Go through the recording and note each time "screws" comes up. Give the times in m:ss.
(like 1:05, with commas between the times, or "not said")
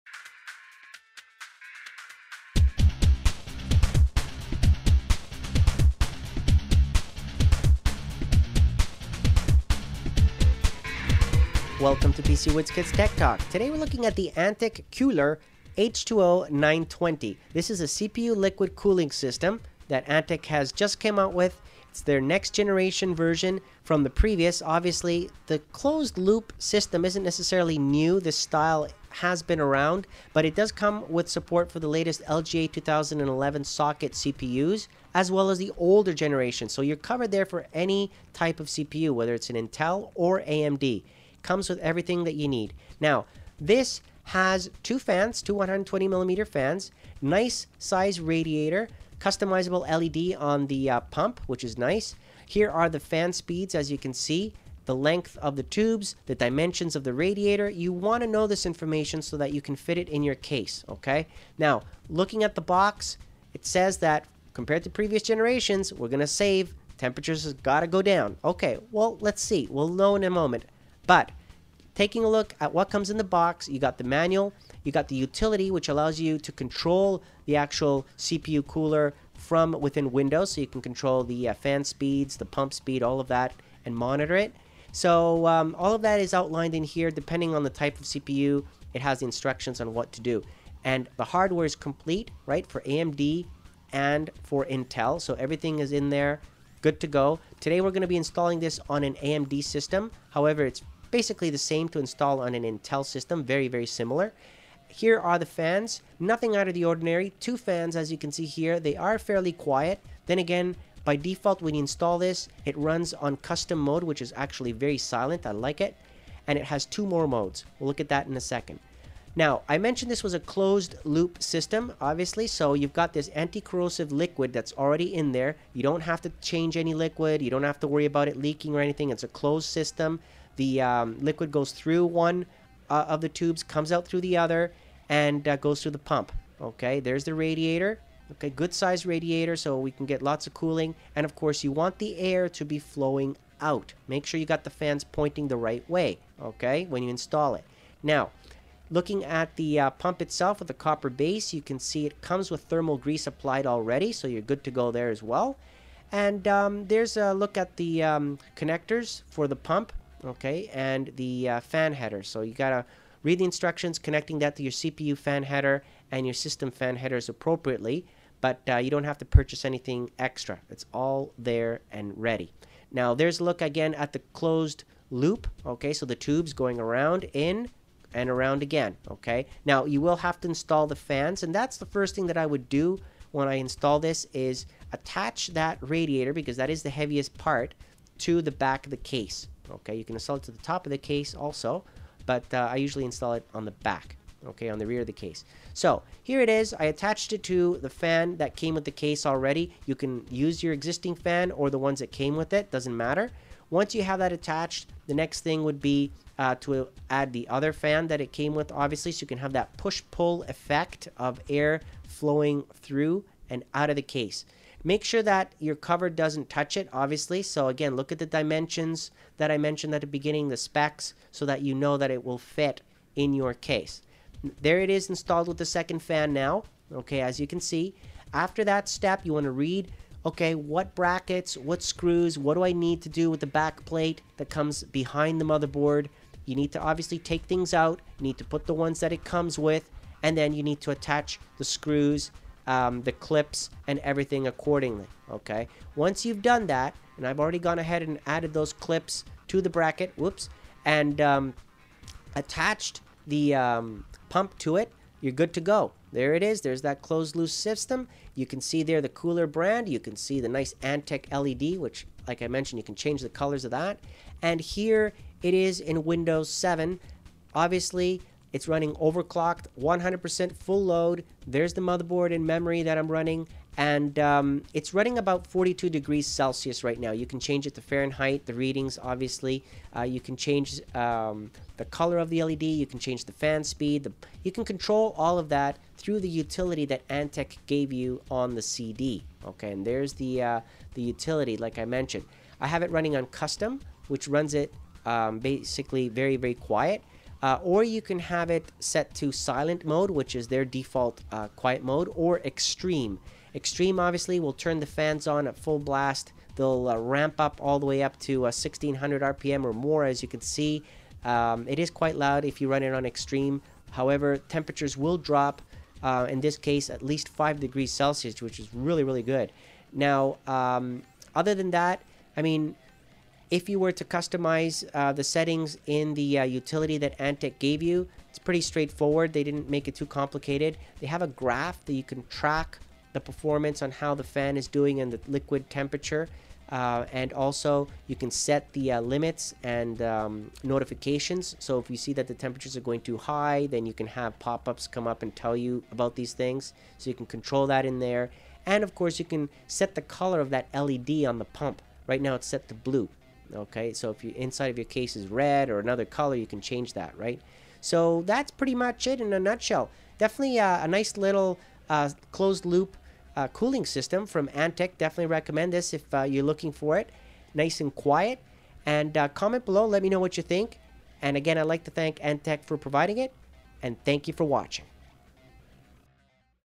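3:51, 4:01.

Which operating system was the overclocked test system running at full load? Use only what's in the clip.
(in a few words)
Windows 7.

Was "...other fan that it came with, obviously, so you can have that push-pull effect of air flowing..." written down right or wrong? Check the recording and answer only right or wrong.
right.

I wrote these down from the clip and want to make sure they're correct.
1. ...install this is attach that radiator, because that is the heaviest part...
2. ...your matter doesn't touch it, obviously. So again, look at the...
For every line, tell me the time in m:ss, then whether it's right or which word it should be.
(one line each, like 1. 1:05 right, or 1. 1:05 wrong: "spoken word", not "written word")
1. 3:03 right
2. 3:35 wrong: "cover", not "matter".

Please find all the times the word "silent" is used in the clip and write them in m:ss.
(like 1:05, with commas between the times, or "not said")
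1:54, 4:59.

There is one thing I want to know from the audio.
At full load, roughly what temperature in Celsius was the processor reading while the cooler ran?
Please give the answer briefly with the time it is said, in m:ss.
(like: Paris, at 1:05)
42, at 4:35.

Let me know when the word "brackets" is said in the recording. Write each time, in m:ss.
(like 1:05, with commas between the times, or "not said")
3:50, 4:09.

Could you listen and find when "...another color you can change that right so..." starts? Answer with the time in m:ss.
5:55.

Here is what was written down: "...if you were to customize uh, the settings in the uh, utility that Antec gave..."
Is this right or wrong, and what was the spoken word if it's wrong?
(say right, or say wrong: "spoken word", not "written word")
right.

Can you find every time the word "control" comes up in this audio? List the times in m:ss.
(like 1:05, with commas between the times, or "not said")
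1:16, 1:20, 4:44, 5:47.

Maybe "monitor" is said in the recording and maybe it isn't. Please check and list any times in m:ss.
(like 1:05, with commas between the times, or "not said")
1:23.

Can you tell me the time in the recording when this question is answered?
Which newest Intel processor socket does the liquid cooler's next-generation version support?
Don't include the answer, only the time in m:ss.
0:32.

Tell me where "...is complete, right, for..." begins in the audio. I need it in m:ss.
1:31.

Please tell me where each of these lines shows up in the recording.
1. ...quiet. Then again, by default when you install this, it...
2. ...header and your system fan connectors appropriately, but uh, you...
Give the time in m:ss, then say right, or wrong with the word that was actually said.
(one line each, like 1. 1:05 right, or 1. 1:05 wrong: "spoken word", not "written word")
1. 1:49 right
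2. 2:45 wrong: "headers", not "connectors".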